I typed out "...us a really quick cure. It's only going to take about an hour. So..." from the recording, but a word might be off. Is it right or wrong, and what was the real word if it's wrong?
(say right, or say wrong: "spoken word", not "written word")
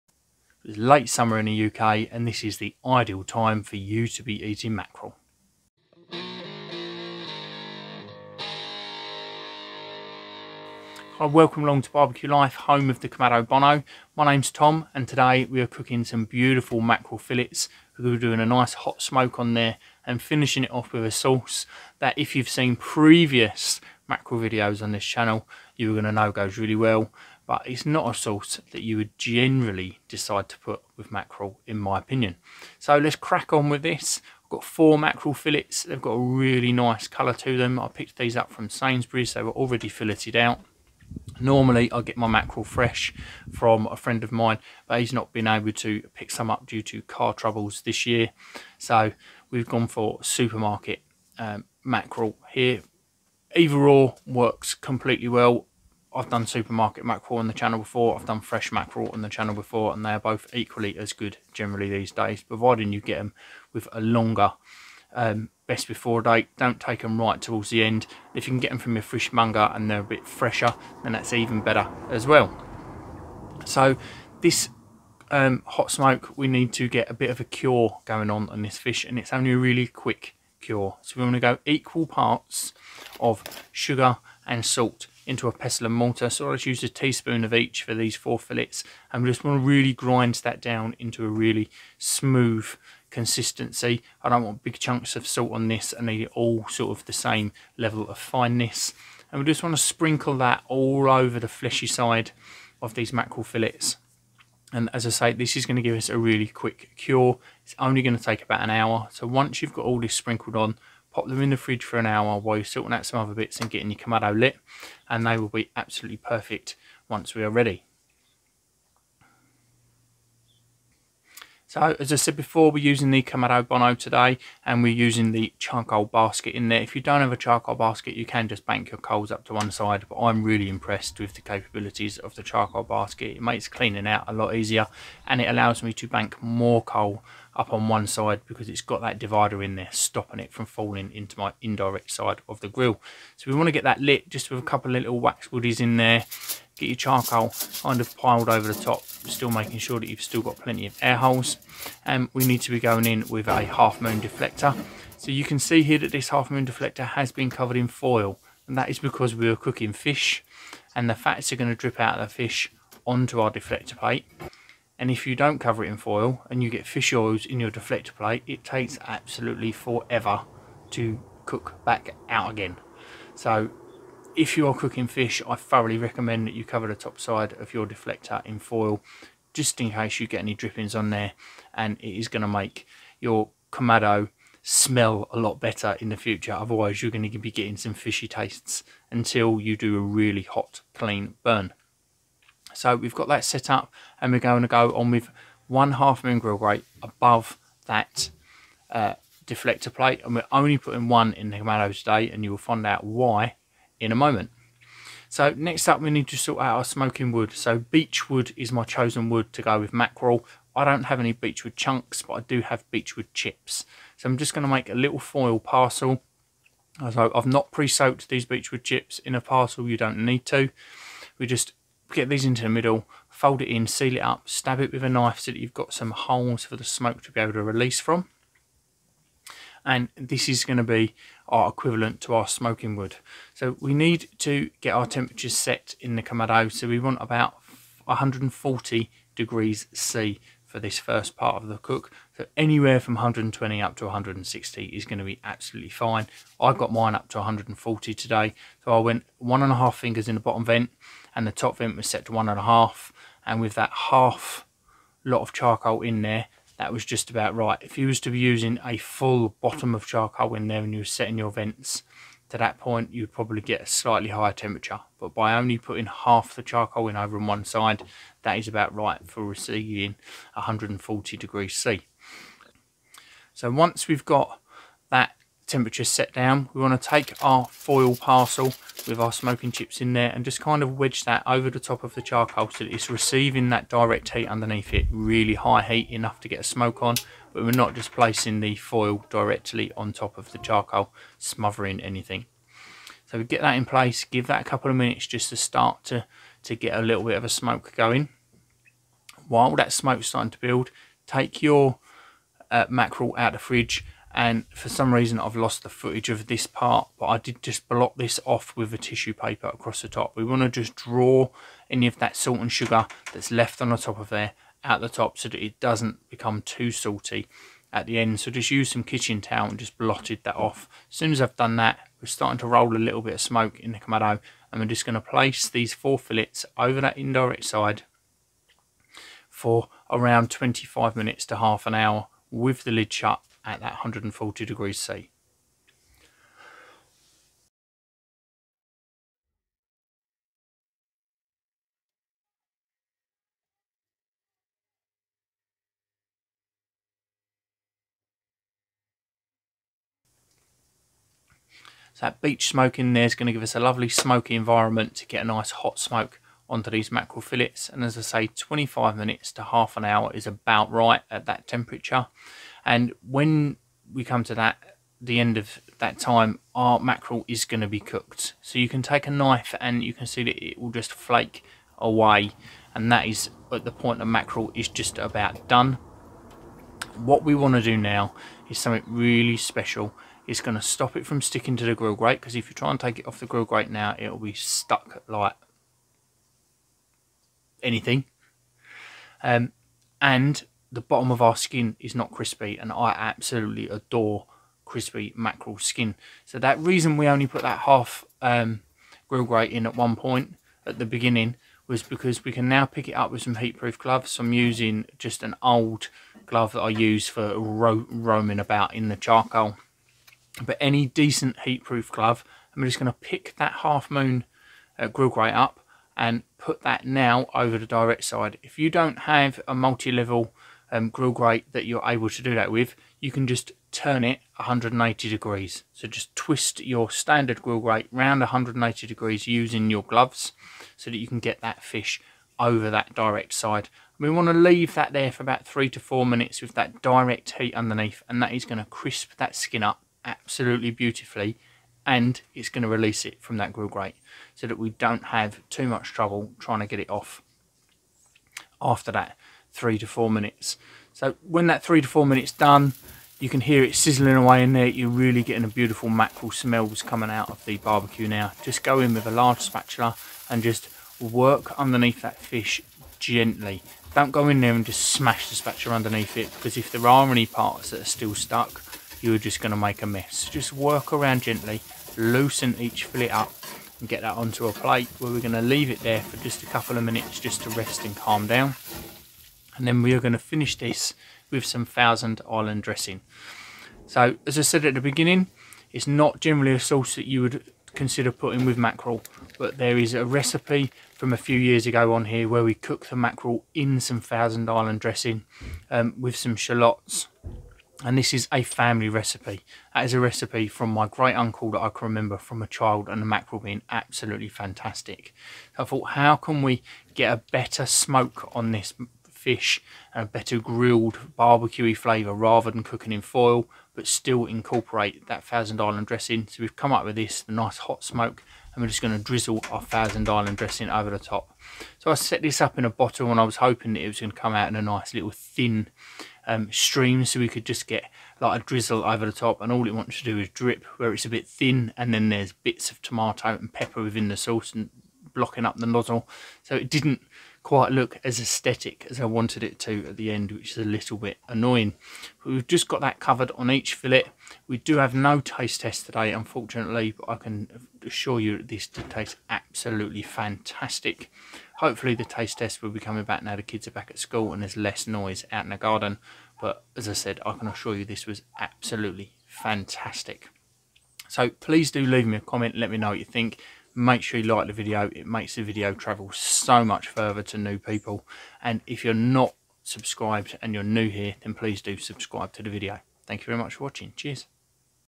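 right.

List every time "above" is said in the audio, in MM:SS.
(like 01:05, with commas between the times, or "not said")
03:17.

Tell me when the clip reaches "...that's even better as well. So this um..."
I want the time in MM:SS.
01:11.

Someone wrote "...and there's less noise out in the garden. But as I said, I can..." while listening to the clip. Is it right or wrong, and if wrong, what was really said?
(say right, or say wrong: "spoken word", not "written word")
right.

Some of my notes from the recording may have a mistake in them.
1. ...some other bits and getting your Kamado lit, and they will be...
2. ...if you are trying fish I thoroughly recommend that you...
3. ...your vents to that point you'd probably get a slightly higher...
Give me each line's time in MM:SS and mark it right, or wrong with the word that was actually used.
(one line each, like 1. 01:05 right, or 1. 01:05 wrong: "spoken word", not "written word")
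1. 01:53 right
2. 02:54 wrong: "cooking", not "trying"
3. 04:21 right.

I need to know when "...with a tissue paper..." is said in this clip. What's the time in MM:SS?
05:08.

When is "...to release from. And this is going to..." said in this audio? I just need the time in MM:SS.
03:47.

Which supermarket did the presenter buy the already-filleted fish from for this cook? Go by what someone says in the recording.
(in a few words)
Sainsbury's.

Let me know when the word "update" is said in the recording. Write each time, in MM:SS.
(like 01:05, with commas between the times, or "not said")
not said.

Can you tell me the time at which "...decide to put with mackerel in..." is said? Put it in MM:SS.
00:30.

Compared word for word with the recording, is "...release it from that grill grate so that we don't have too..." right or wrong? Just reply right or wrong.
right.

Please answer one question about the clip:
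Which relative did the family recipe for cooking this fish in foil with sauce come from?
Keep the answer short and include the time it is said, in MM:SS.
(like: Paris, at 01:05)
great uncle, at 08:21.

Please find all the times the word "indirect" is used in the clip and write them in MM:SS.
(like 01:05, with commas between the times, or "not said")
02:21, 05:27.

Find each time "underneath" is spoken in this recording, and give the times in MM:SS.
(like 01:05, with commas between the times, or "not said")
04:44, 07:17, 07:41, 07:45.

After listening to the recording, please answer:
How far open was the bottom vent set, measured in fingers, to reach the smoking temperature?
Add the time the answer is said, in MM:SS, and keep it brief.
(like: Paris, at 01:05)
1.5 fingers, at 04:09.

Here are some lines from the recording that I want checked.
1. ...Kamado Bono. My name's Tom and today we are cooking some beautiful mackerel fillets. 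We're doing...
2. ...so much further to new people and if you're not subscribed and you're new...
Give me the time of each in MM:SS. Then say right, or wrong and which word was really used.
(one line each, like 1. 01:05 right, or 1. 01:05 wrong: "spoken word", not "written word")
1. 00:13 right
2. 09:26 right.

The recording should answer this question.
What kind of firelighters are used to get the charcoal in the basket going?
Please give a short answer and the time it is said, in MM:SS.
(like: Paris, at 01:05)
wax woodies, at 02:25.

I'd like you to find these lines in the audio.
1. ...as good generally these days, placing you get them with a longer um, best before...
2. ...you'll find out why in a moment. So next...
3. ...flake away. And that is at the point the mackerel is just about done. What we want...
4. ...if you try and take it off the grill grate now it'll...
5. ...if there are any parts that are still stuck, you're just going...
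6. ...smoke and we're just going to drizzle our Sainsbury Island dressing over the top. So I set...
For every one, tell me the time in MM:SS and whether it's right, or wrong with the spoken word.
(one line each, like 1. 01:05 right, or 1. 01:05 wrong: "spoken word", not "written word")
1. 01:00 wrong: "providing", not "placing"
2. 03:22 right
3. 06:11 right
4. 06:22 right
5. 07:46 right
6. 08:38 wrong: "Thousand", not "Sainsbury".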